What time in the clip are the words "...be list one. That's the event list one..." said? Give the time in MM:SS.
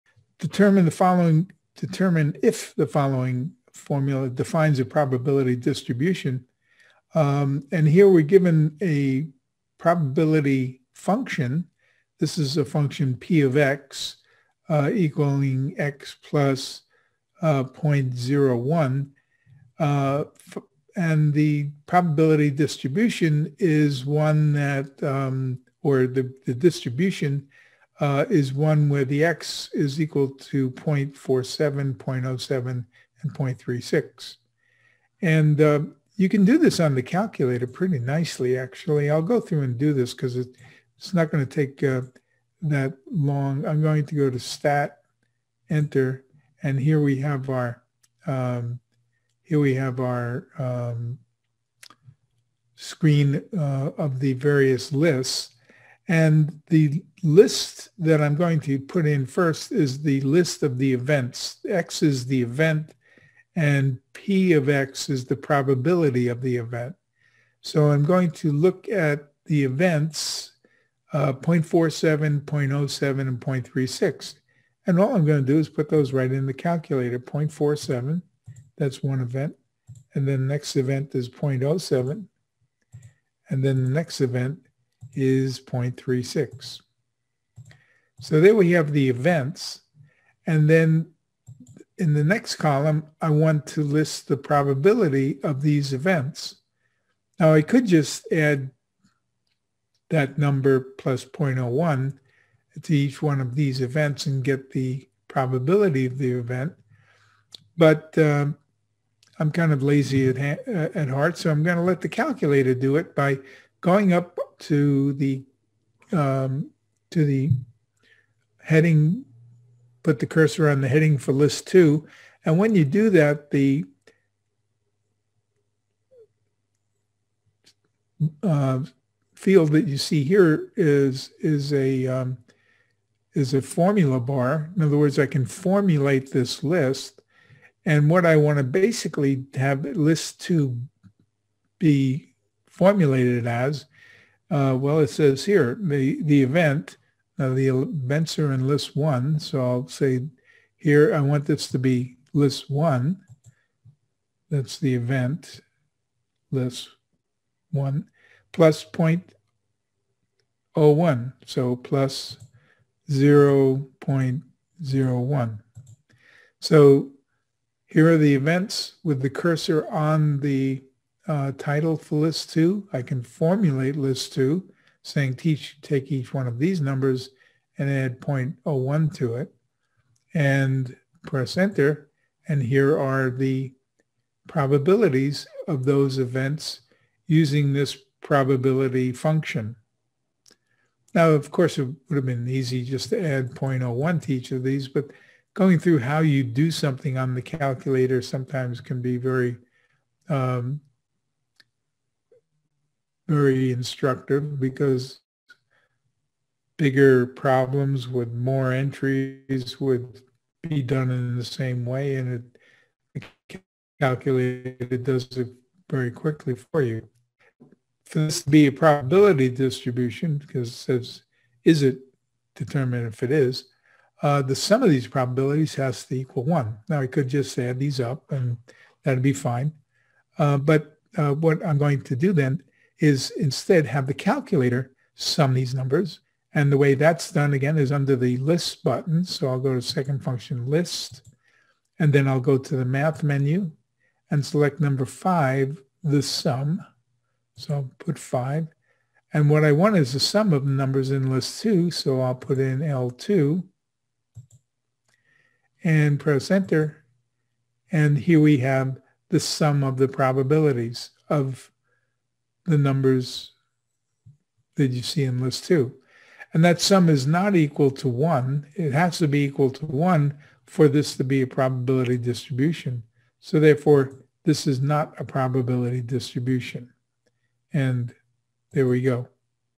02:31.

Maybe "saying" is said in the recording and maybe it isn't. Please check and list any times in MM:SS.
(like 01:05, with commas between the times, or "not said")
02:55.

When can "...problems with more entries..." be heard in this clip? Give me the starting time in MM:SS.
03:27.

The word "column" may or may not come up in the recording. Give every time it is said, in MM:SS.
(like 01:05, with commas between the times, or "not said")
01:32.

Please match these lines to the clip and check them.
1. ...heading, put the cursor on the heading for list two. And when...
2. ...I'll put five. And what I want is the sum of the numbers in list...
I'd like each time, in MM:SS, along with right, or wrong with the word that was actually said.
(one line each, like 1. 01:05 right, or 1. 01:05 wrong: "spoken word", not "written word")
1. 01:58 right
2. 04:07 right.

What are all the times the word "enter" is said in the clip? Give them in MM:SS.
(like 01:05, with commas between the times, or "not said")
00:45, 03:01, 04:16.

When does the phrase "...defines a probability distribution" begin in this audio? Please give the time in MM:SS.
00:04.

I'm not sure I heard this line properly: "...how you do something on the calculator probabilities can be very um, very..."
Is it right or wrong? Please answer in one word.
wrong.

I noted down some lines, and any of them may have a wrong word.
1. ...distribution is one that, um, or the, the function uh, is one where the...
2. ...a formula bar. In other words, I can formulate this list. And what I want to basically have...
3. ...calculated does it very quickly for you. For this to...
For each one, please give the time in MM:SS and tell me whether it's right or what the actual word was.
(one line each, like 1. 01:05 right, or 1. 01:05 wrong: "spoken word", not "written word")
1. 00:22 wrong: "distribution", not "function"
2. 02:13 right
3. 03:33 right.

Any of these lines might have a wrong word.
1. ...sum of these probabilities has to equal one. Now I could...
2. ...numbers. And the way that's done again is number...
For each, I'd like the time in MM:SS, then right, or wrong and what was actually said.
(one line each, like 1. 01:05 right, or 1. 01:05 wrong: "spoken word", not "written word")
1. 03:44 right
2. 03:55 wrong: "under", not "number".